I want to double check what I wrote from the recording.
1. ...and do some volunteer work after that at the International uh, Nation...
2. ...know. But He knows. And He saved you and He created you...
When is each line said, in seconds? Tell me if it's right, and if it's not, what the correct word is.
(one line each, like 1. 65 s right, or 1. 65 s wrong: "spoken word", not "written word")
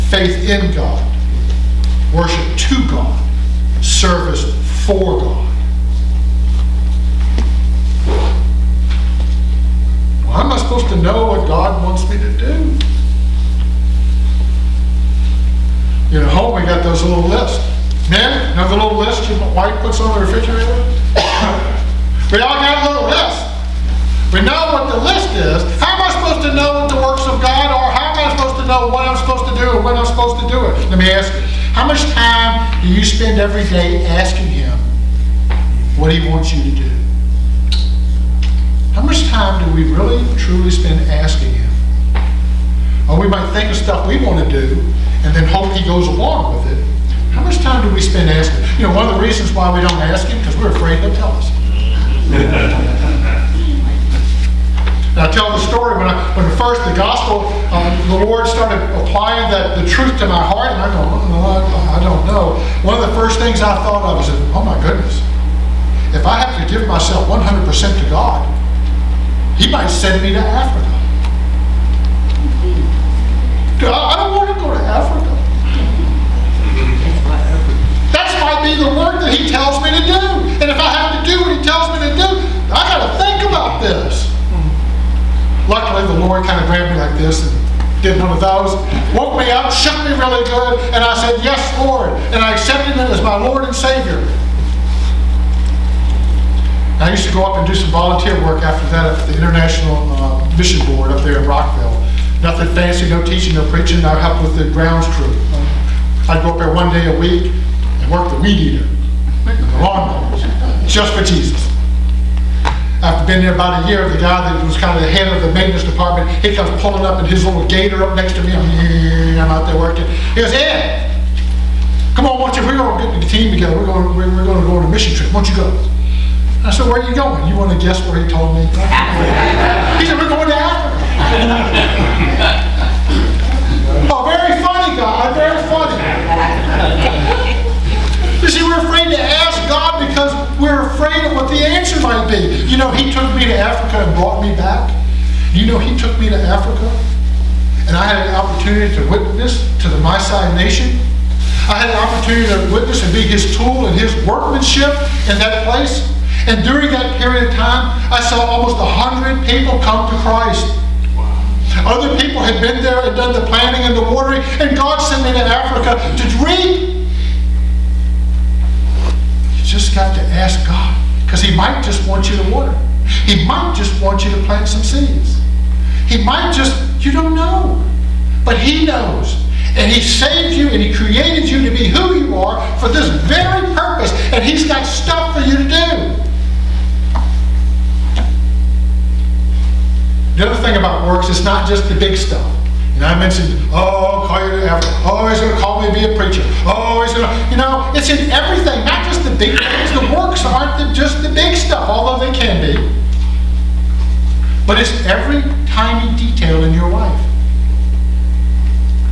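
1. 97 s wrong: "Mission", not "Nation"
2. 177 s right.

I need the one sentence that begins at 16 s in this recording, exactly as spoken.
You know, home we got those little lists.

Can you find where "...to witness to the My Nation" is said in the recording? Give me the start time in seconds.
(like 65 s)
148 s.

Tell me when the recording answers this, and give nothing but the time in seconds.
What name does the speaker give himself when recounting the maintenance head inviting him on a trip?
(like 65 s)
120 s.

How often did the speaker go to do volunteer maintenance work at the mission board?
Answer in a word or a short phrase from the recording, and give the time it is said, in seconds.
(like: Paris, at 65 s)
One day a week, at 106 s.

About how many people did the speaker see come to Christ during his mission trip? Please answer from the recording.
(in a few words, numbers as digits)
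Almost 100.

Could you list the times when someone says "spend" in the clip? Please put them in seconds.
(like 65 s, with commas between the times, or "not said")
33 s, 40 s, 48 s.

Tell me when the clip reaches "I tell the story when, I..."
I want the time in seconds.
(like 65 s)
55 s.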